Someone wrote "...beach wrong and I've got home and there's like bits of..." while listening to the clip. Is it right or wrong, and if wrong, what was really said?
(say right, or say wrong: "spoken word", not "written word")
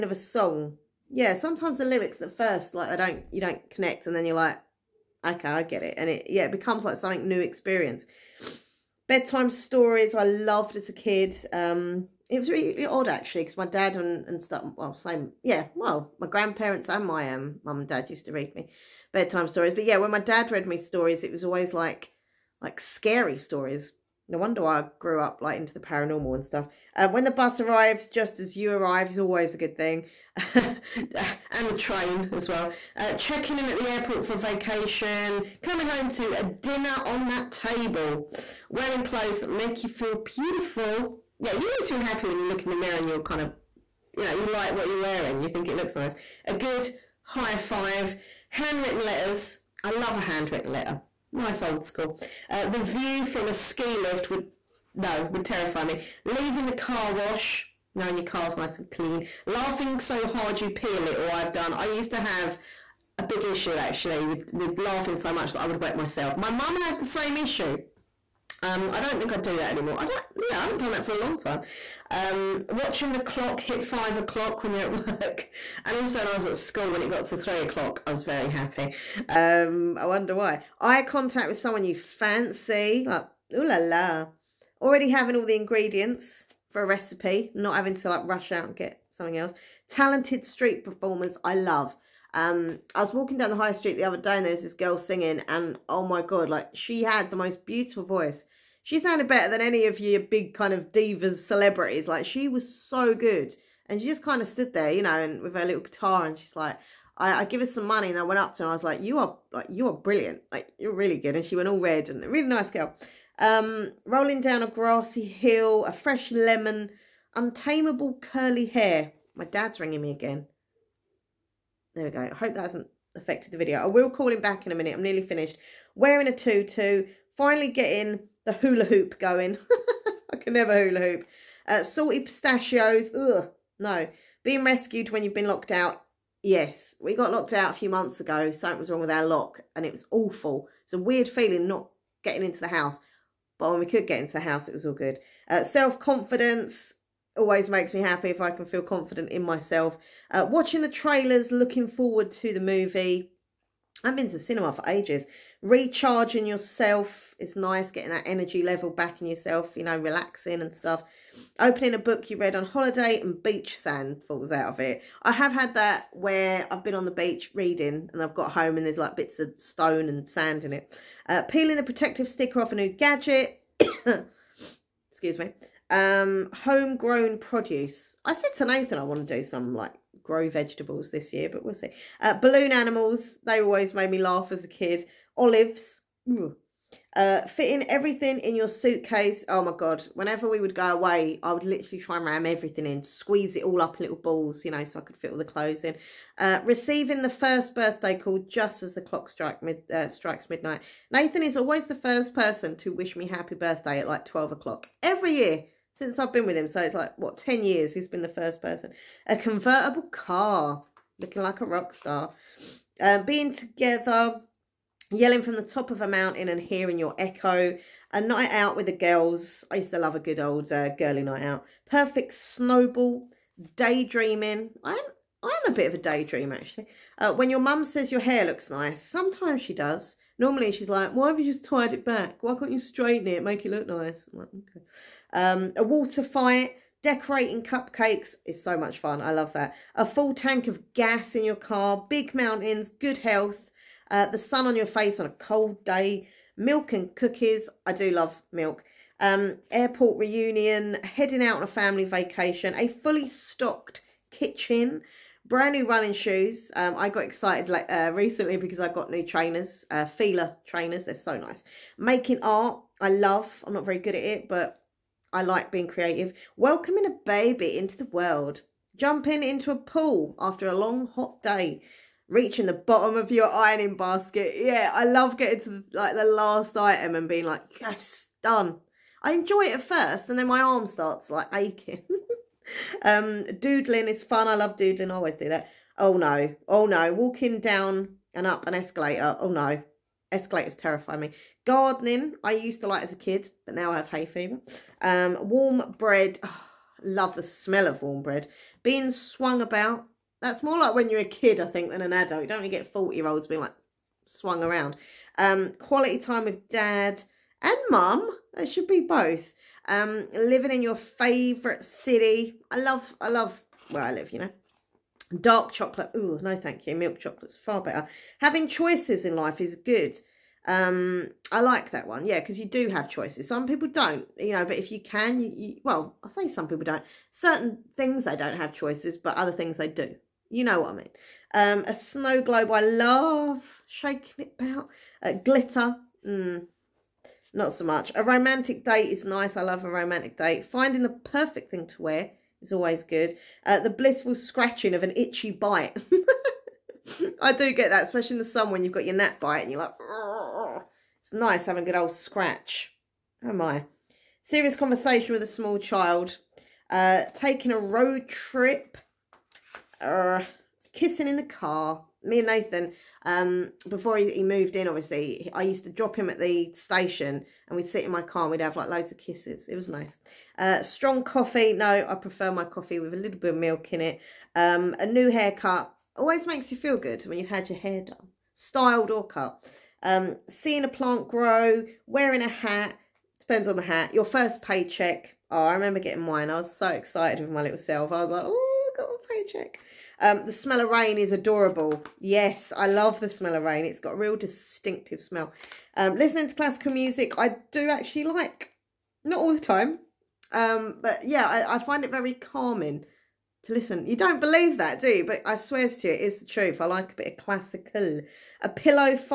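wrong: "reading", not "wrong".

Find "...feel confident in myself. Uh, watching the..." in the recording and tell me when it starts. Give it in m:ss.
2:28.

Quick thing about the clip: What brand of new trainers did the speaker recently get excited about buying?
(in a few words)
Fila.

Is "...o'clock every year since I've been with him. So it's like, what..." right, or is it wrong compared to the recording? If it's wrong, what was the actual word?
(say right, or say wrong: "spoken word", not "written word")
right.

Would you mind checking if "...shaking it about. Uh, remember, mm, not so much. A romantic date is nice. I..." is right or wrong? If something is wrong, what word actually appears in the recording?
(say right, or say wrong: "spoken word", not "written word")
wrong: "glitter", not "remember".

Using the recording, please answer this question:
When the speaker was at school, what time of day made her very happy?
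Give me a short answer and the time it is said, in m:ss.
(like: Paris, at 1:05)
three o'clock, at 1:17.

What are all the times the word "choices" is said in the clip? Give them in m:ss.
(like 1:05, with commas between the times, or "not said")
5:18, 5:23, 5:28.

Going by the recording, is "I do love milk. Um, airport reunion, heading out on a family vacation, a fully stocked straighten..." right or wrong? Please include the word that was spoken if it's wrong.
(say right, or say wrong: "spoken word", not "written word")
wrong: "kitchen", not "straighten".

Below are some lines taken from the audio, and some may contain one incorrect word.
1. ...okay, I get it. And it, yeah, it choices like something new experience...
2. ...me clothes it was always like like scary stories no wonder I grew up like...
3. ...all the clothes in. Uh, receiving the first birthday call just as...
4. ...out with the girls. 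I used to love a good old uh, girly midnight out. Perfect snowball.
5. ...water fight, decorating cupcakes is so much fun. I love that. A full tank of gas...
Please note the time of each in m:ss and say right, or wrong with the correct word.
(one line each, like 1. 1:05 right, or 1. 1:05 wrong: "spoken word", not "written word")
1. 0:05 wrong: "becomes", not "choices"
2. 0:20 wrong: "stories", not "clothes"
3. 3:15 right
4. 3:38 wrong: "night", not "midnight"
5. 3:55 right.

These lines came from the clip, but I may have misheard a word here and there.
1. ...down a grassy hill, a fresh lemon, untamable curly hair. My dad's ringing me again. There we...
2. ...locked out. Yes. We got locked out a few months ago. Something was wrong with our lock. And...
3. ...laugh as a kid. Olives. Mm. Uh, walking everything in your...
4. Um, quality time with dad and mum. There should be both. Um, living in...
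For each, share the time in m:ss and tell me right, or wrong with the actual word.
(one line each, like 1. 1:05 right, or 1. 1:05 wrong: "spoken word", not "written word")
1. 1:54 right
2. 2:15 right
3. 3:04 wrong: "fitting", not "walking"
4. 5:05 right.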